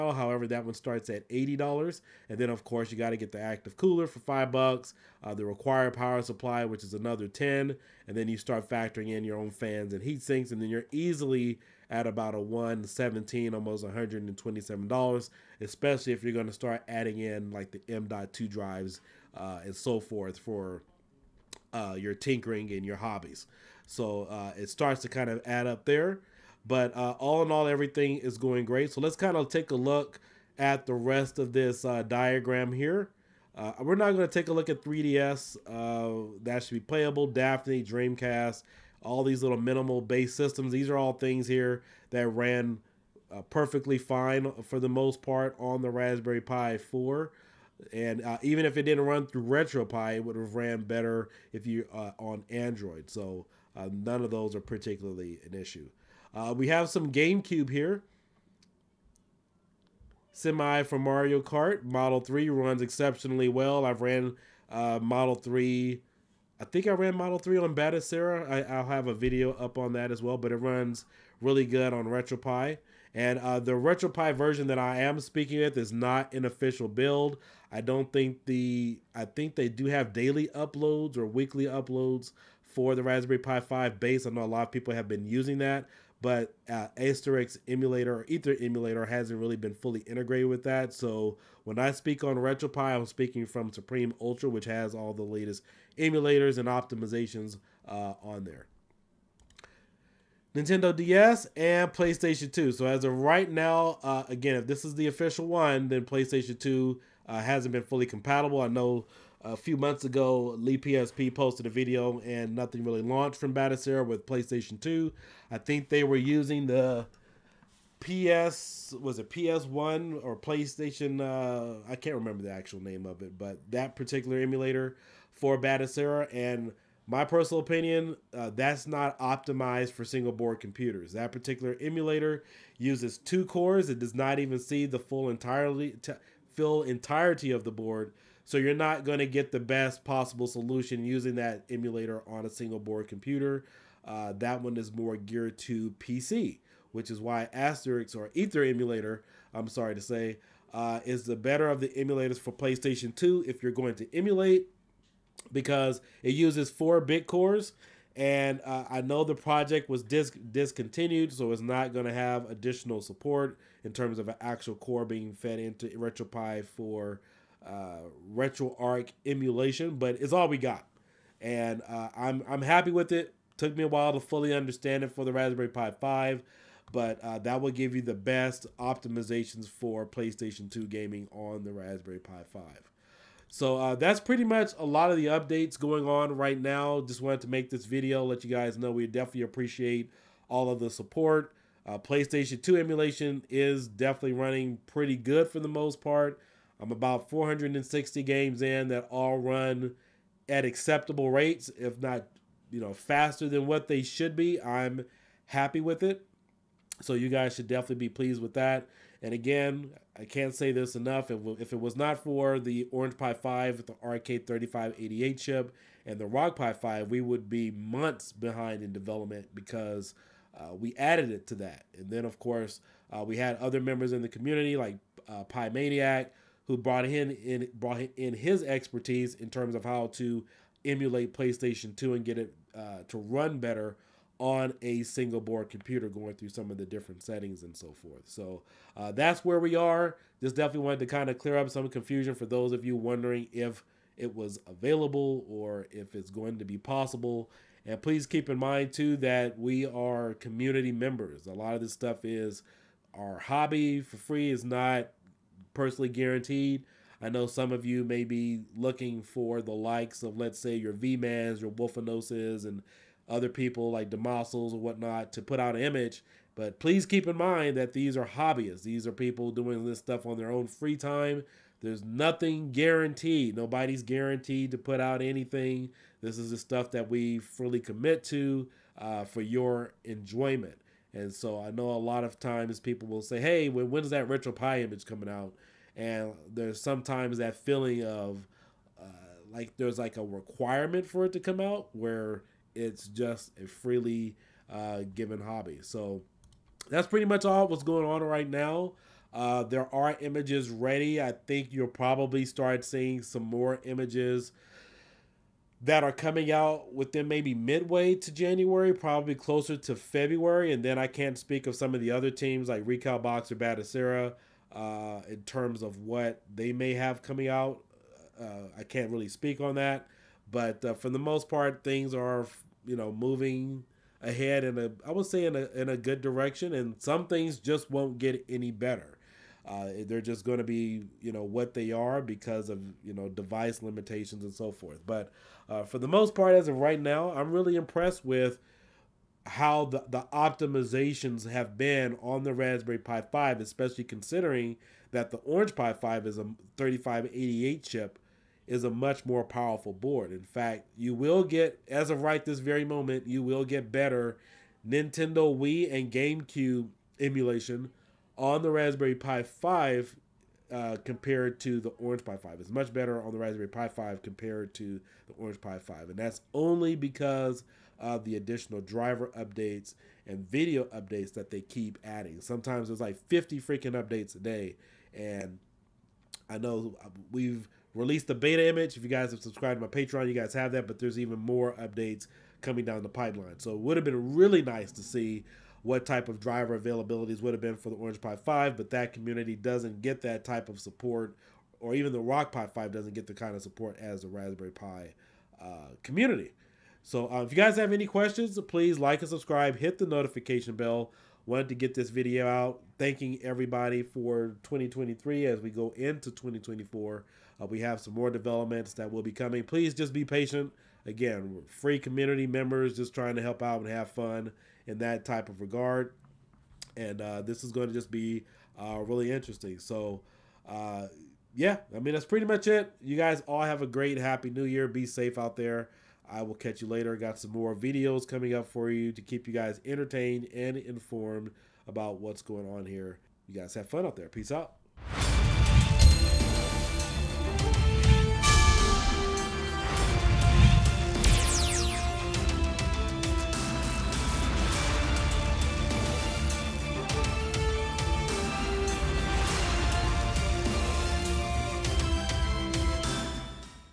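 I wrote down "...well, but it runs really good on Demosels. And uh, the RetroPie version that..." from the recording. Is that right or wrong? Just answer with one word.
wrong.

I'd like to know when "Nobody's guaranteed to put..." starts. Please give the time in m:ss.
4:33.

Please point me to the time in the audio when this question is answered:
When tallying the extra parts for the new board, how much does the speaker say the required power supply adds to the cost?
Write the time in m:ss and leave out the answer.
0:06.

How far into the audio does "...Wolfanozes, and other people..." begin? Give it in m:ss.
4:21.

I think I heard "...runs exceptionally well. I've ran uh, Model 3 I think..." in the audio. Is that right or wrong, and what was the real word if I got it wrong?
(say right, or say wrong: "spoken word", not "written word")
right.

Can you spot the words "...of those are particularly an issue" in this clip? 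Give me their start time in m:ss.
0:54.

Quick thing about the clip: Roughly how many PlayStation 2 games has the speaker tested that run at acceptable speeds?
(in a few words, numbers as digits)
460.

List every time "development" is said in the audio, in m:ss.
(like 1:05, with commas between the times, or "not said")
3:38, 6:48.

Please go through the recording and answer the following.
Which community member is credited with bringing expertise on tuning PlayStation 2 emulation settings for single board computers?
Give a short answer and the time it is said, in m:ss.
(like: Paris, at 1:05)
Pi Maniac, at 3:45.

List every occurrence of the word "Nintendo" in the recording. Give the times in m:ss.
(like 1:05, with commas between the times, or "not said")
1:40, 5:54.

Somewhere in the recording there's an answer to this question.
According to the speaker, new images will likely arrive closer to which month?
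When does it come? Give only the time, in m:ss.
5:09.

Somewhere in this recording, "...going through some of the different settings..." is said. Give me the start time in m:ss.
3:56.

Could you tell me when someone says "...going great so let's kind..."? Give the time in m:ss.
0:28.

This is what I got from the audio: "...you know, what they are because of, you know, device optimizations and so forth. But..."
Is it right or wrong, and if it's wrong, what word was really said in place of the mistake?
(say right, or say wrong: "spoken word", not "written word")
wrong: "limitations", not "optimizations".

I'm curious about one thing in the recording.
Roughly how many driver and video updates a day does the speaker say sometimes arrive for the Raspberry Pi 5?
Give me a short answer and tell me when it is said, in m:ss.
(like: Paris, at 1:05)
50, at 6:13.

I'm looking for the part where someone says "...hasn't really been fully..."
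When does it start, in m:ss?
1:29.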